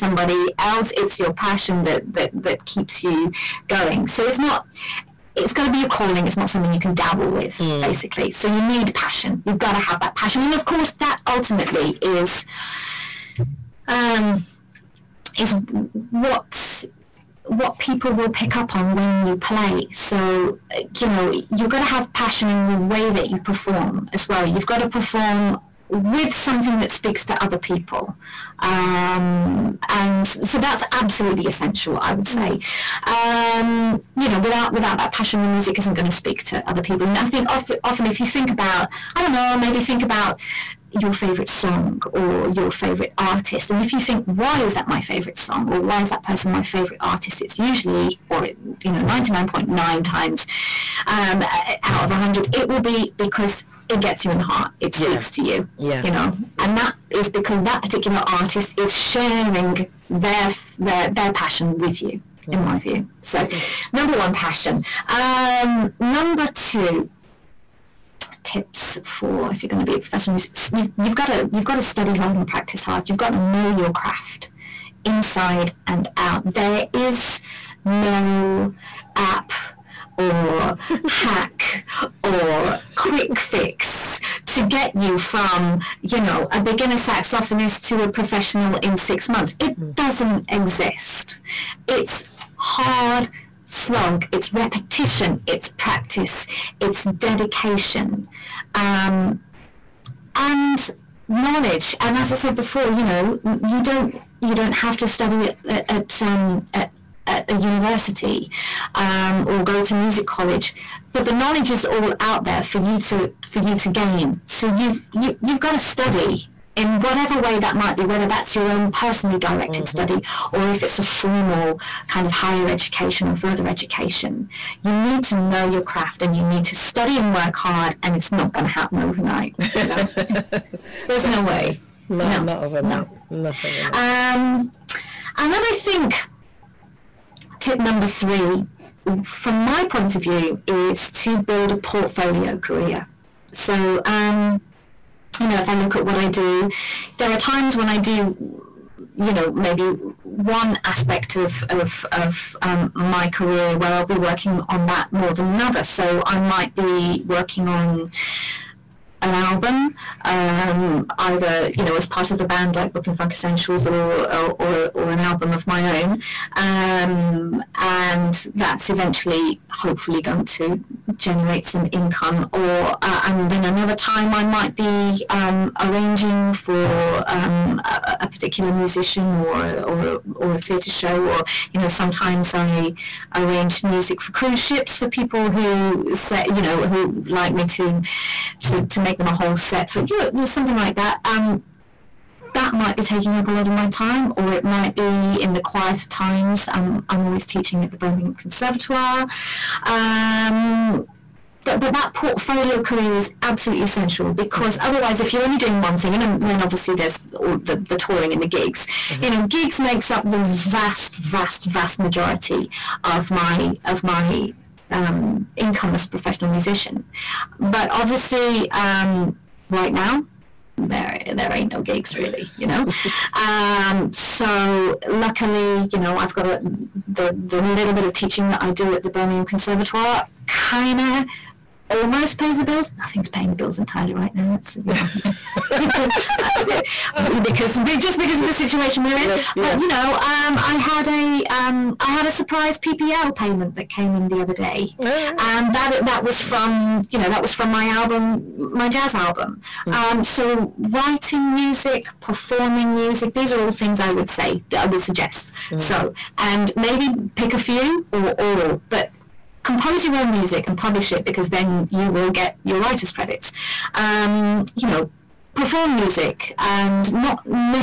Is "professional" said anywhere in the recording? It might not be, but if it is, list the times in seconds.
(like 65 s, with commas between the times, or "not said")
69 s, 88 s, 216 s.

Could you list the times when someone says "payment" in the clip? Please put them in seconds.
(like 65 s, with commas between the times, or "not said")
243 s.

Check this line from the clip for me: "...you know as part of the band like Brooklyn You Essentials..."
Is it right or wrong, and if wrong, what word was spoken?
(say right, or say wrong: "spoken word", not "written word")
wrong: "Funk", not "You".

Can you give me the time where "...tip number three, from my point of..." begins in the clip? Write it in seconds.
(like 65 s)
137 s.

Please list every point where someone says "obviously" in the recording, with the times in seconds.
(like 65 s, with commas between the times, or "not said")
206 s, 217 s.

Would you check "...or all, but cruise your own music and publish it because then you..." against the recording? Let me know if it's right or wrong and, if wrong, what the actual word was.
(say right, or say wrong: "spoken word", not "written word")
wrong: "compose", not "cruise".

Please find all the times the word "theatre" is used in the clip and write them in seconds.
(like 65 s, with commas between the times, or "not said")
180 s.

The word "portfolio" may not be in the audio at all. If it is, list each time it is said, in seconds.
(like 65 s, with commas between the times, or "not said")
141 s, 202 s.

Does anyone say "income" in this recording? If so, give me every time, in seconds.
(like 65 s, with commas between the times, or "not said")
171 s, 215 s.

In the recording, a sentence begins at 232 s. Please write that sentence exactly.
Nothing's paying the bills entirely right now.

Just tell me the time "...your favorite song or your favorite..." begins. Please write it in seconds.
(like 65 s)
40 s.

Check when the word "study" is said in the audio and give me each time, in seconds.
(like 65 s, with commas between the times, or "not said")
71 s, 105 s, 115 s, 119 s, 126 s.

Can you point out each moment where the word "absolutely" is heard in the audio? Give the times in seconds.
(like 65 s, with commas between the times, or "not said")
30 s, 203 s.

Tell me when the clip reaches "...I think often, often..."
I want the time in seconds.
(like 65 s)
37 s.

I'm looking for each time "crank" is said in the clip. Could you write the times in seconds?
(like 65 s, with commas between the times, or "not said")
not said.